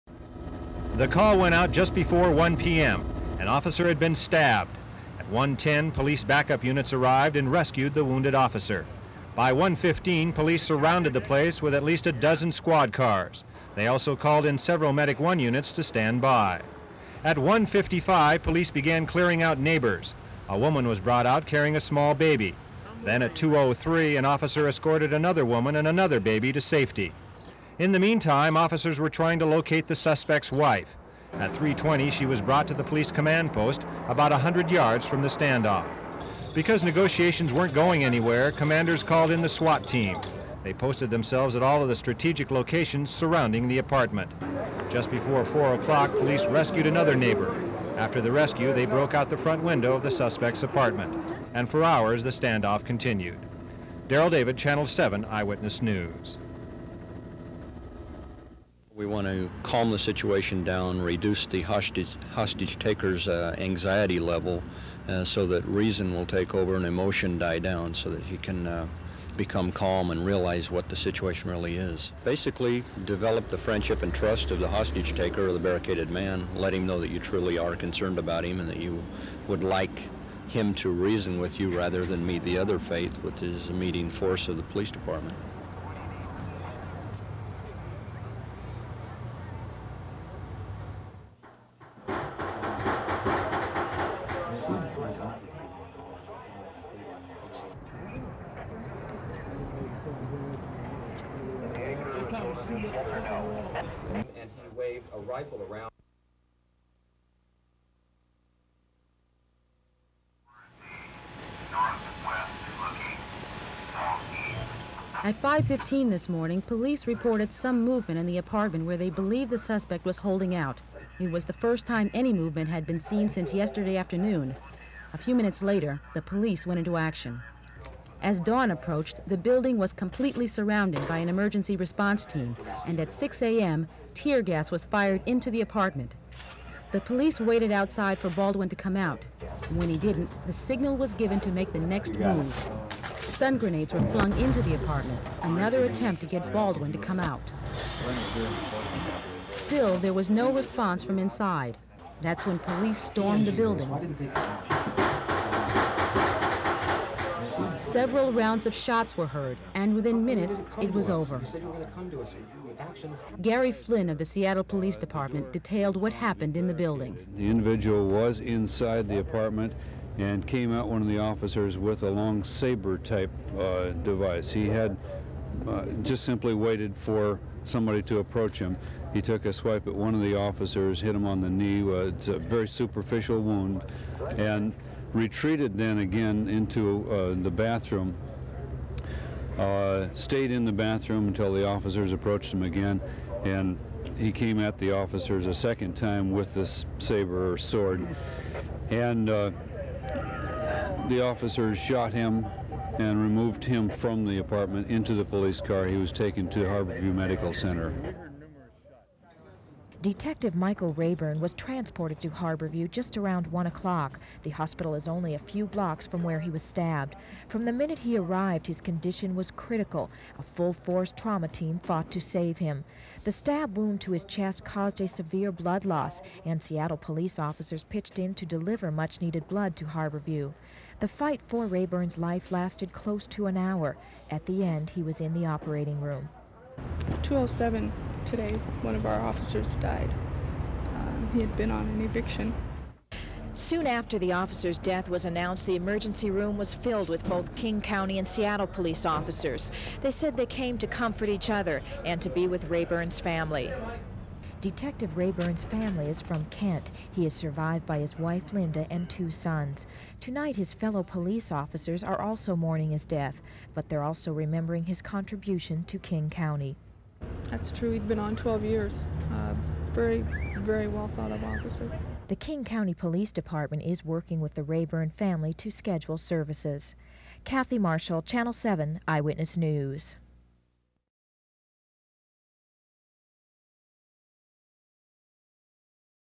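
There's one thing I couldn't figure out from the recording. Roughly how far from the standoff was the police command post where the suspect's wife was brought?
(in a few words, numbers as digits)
100 yards.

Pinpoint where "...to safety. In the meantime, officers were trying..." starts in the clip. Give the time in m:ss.
0:26.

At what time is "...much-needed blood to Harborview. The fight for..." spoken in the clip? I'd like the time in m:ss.
3:48.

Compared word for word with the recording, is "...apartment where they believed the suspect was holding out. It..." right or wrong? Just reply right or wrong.
right.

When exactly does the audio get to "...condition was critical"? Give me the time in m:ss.
3:38.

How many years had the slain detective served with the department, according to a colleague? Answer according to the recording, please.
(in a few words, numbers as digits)
12.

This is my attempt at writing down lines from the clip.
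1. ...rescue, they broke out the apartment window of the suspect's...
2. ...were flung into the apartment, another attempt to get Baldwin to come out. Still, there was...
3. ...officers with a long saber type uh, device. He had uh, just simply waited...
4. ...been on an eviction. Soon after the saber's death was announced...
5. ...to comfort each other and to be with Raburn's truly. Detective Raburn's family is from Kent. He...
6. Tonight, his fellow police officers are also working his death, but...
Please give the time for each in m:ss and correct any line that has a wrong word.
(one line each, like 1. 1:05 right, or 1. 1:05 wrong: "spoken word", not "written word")
1. 0:48 wrong: "front", not "apartment"
2. 2:23 right
3. 2:51 right
4. 4:01 wrong: "officer", not "saber"
5. 4:10 wrong: "family", not "truly"
6. 4:20 wrong: "mourning", not "working".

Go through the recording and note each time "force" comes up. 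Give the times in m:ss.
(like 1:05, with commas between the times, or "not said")
1:24, 3:40.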